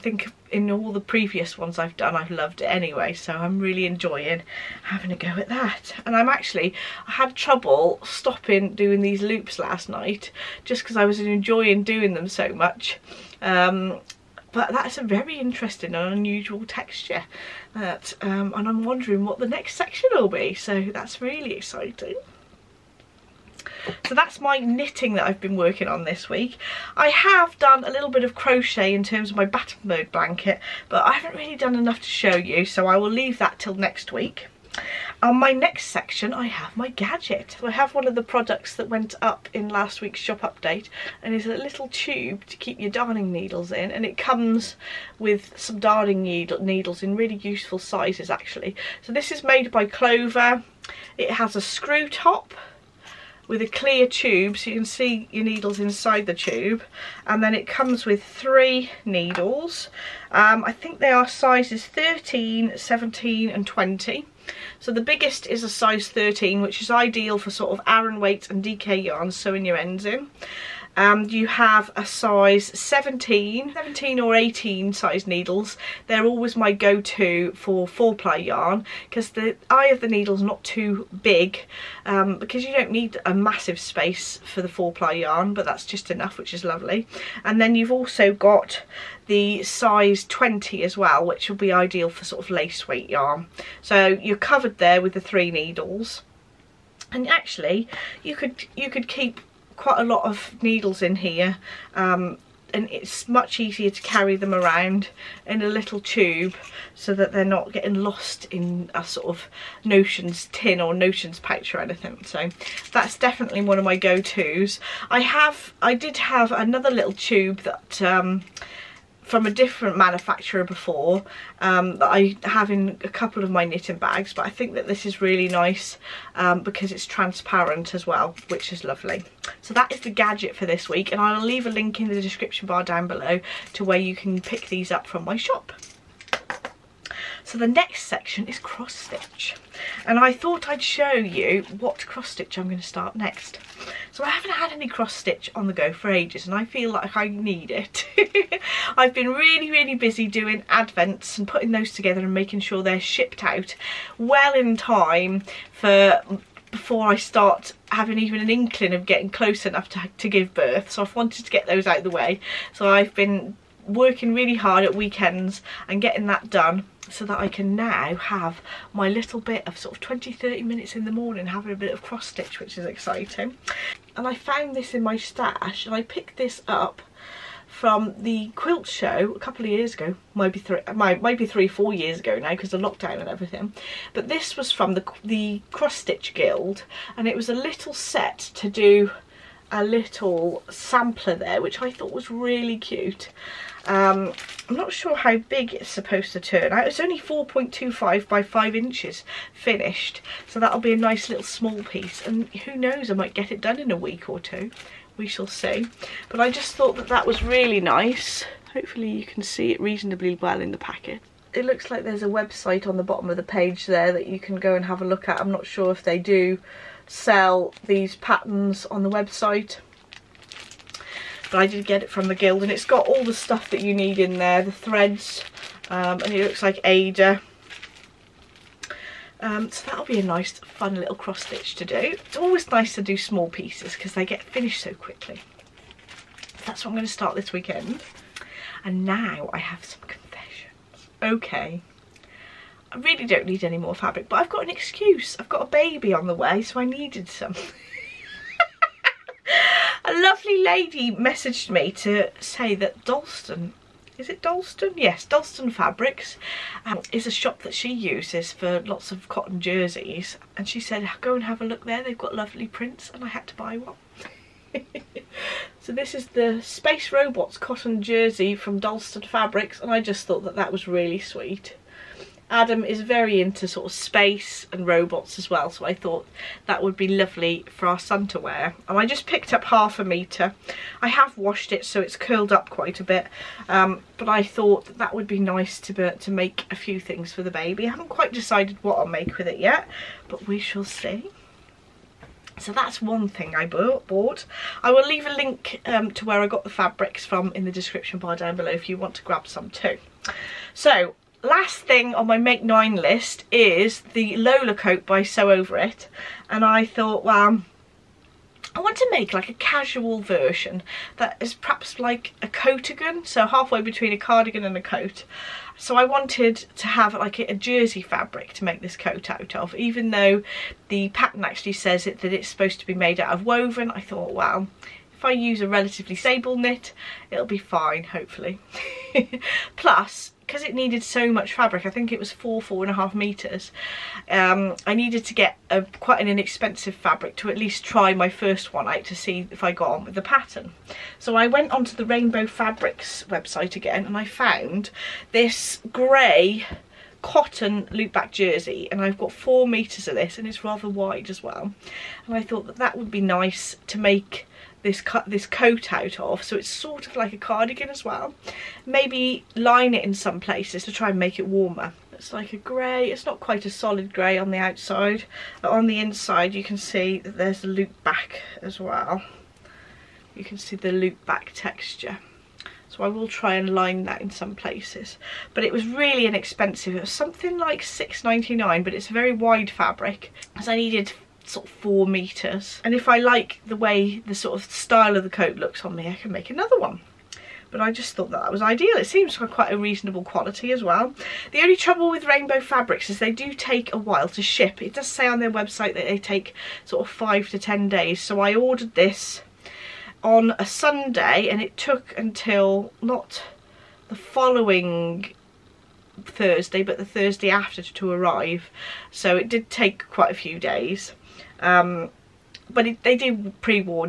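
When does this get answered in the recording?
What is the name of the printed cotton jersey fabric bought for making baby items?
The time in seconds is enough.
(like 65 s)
266 s.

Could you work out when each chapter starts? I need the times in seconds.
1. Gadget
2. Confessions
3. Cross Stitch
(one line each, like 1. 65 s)
1. 34 s
2. 237 s
3. 135 s.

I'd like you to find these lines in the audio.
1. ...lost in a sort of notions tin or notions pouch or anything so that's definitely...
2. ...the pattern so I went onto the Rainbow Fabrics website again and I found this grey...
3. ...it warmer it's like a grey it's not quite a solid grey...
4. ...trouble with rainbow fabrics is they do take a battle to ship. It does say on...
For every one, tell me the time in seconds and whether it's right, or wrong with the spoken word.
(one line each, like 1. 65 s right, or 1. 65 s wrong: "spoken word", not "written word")
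1. 107 s right
2. 340 s right
3. 361 s right
4. 391 s wrong: "while", not "battle".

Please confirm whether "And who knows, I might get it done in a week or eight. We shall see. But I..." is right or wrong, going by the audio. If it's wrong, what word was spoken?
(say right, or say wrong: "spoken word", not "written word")
wrong: "two", not "eight".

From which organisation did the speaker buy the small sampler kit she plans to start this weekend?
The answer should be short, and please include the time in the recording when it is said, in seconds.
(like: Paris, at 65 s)
The Cross Stitch Guild, at 185 s.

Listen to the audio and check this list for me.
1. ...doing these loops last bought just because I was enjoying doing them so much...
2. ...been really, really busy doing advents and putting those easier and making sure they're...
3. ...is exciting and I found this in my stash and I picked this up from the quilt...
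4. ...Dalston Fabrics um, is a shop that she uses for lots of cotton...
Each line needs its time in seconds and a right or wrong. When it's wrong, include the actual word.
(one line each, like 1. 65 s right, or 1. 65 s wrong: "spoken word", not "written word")
1. 8 s wrong: "night", not "bought"
2. 149 s wrong: "together", not "easier"
3. 172 s right
4. 255 s right.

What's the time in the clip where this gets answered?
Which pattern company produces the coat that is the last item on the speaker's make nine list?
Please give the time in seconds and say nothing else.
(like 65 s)
305 s.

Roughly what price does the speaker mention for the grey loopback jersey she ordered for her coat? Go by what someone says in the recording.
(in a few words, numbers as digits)
6.99.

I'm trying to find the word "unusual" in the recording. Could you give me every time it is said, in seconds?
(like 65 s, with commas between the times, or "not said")
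16 s.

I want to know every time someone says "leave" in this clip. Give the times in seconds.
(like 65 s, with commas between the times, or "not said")
33 s, 131 s, 295 s.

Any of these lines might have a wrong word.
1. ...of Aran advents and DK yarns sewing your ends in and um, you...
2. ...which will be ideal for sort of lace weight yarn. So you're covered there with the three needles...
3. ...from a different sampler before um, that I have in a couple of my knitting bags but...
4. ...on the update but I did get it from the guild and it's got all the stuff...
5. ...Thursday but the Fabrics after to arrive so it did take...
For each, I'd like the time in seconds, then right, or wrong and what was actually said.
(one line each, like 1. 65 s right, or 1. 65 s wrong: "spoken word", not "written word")
1. 67 s wrong: "weights", not "advents"
2. 91 s right
3. 119 s wrong: "manufacturer", not "sampler"
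4. 218 s wrong: "website", not "update"
5. 406 s wrong: "Thursday", not "Fabrics".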